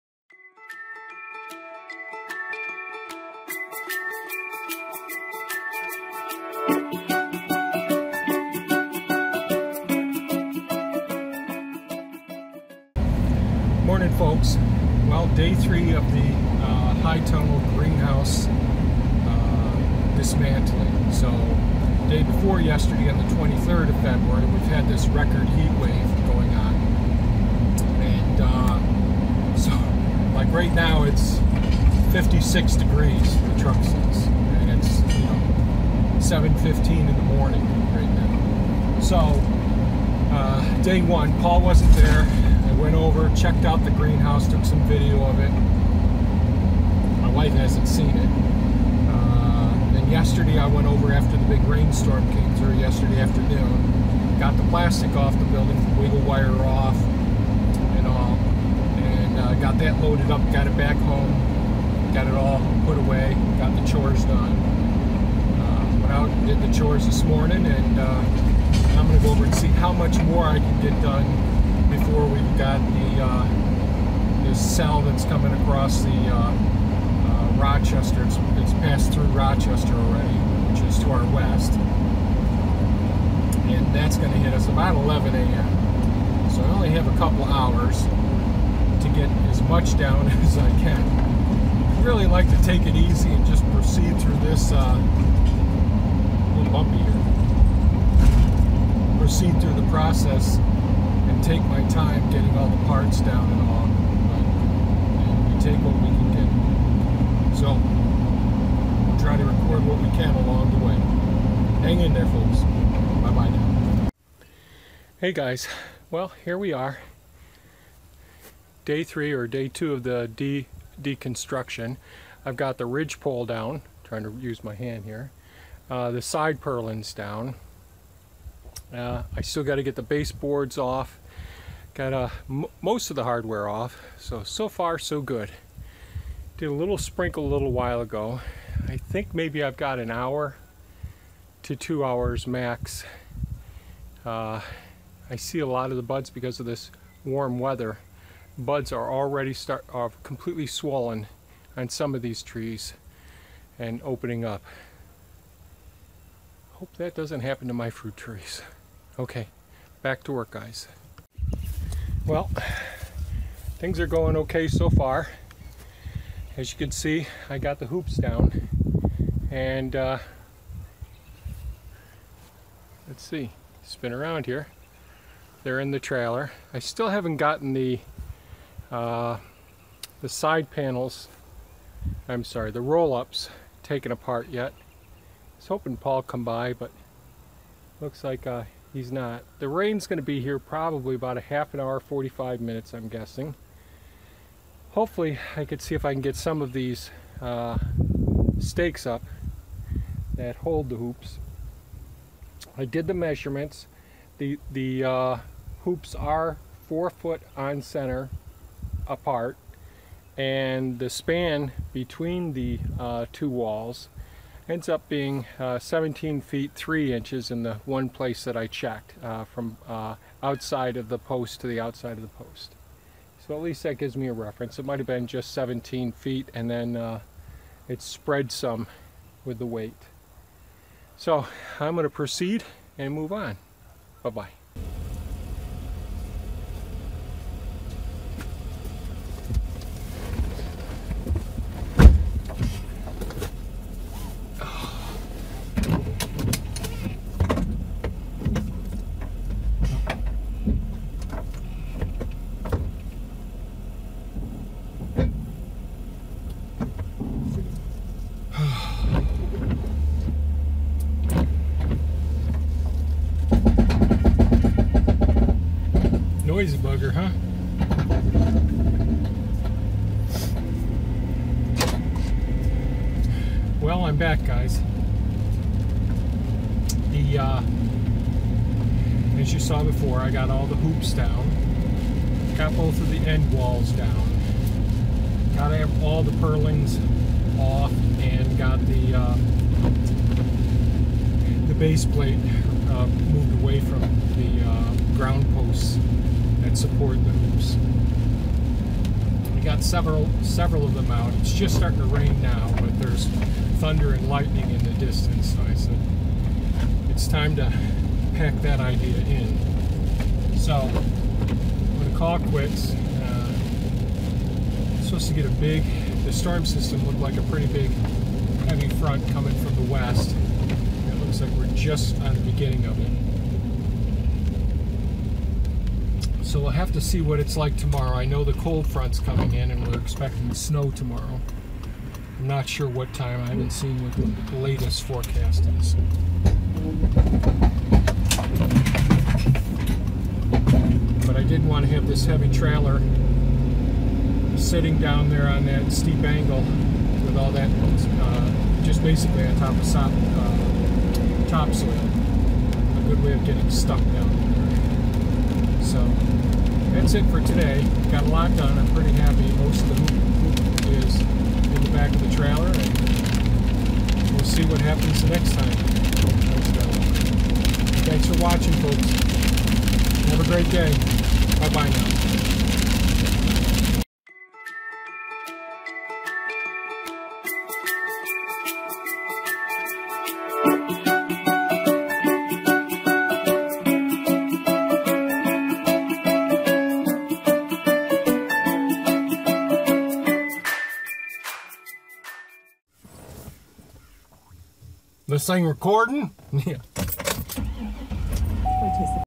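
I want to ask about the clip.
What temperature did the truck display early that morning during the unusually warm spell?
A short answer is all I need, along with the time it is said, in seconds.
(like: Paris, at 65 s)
56 degrees, at 32 s.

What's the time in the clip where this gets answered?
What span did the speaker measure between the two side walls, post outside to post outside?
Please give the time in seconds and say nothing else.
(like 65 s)
215 s.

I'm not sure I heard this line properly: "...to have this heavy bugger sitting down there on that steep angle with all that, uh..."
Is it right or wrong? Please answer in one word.
wrong.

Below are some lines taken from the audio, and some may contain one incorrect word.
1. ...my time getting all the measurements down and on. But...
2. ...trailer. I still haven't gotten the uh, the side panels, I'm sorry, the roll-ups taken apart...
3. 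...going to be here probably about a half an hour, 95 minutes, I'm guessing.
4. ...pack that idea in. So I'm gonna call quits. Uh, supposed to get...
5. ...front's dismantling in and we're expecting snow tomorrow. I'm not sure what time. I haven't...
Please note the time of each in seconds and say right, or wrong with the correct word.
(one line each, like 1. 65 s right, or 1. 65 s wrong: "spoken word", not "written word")
1. 101 s wrong: "parts", not "measurements"
2. 175 s right
3. 190 s wrong: "45", not "95"
4. 308 s right
5. 328 s wrong: "coming", not "dismantling".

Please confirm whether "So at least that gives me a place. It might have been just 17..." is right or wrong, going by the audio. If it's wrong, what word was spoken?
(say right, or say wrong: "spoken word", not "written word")
wrong: "reference", not "place".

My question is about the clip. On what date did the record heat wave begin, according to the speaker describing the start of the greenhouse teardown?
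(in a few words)
February 23.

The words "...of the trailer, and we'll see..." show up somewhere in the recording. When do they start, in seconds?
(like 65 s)
362 s.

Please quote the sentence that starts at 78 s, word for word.
It's, it's passed through Rochester already, which is to our west.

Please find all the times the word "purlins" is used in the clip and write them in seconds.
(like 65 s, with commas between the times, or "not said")
126 s, 286 s.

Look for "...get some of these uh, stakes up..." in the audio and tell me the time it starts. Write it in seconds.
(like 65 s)
196 s.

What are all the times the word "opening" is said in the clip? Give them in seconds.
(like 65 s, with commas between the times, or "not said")
154 s.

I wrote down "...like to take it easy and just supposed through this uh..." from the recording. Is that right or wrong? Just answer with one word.
wrong.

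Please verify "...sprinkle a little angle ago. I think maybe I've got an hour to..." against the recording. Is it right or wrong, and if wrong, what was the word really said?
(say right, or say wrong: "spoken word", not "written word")
wrong: "while", not "angle".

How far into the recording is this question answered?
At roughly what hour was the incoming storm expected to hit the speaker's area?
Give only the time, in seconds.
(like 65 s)
84 s.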